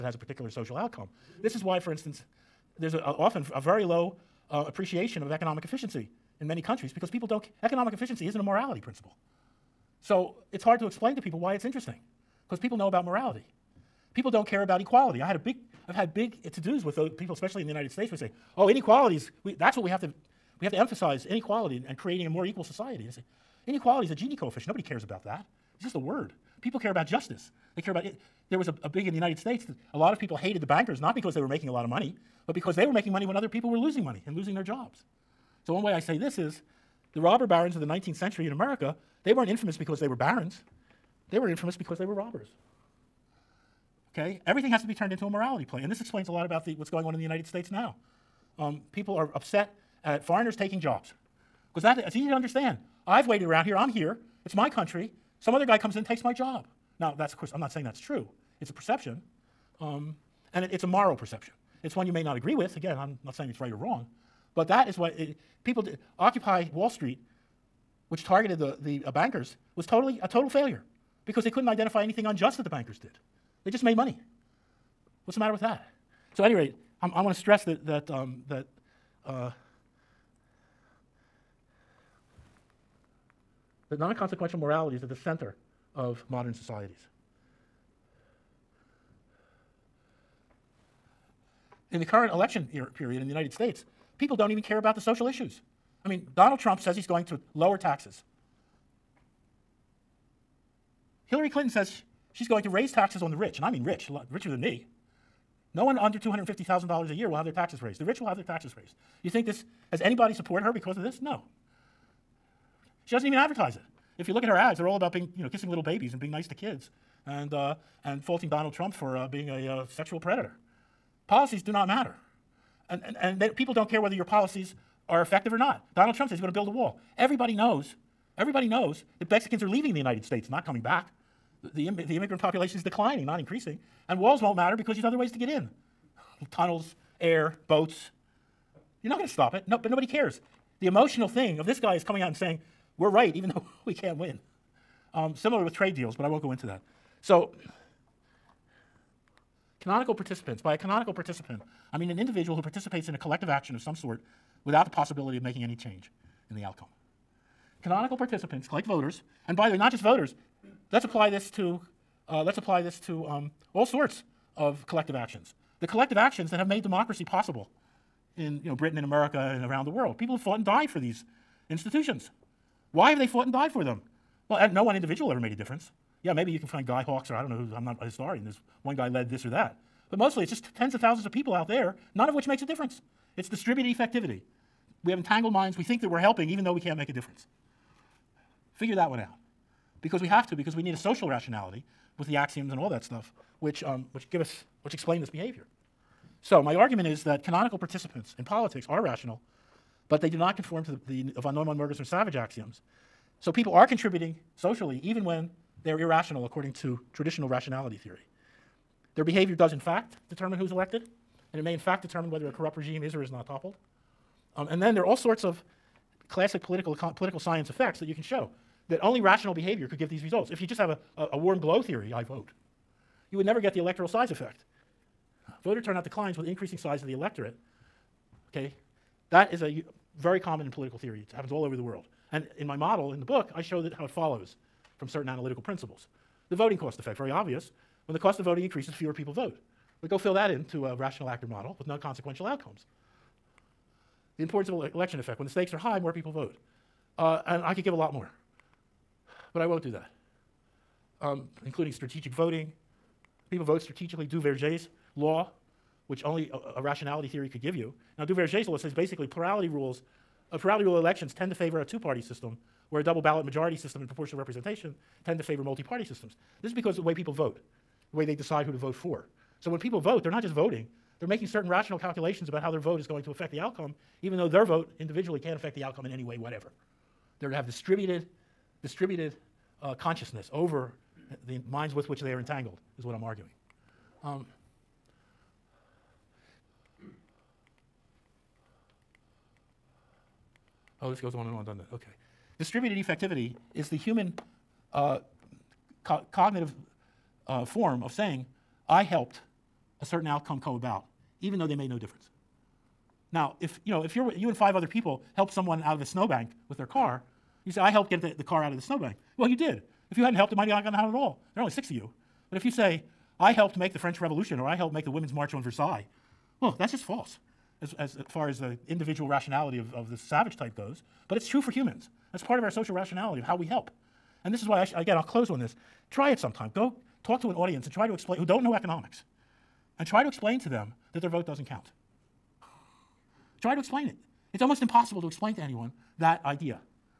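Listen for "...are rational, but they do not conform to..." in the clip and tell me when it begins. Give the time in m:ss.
3:18.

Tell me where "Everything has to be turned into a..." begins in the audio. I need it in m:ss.
0:44.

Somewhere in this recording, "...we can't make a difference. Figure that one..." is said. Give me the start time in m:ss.
3:06.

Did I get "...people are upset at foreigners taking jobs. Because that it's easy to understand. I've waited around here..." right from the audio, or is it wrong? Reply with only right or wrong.
right.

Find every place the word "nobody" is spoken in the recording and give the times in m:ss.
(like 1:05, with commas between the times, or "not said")
0:24, 2:19.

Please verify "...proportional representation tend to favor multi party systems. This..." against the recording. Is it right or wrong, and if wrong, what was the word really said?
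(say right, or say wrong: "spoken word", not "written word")
right.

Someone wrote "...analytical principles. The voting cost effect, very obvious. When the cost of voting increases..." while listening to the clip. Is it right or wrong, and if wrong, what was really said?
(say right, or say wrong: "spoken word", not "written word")
right.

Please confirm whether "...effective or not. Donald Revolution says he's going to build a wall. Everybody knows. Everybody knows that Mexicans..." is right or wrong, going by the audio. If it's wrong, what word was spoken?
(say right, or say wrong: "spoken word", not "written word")
wrong: "Trump", not "Revolution".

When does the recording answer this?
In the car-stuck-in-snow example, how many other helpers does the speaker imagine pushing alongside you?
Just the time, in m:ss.
5:04.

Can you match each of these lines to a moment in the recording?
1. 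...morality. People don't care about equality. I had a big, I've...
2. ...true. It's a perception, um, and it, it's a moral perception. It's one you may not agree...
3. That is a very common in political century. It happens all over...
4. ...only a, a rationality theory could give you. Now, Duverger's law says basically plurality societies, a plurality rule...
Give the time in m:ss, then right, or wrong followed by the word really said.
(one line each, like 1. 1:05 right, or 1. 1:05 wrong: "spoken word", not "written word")
1. 0:13 right
2. 0:57 right
3. 3:49 wrong: "theory", not "century"
4. 4:16 wrong: "rules", not "societies".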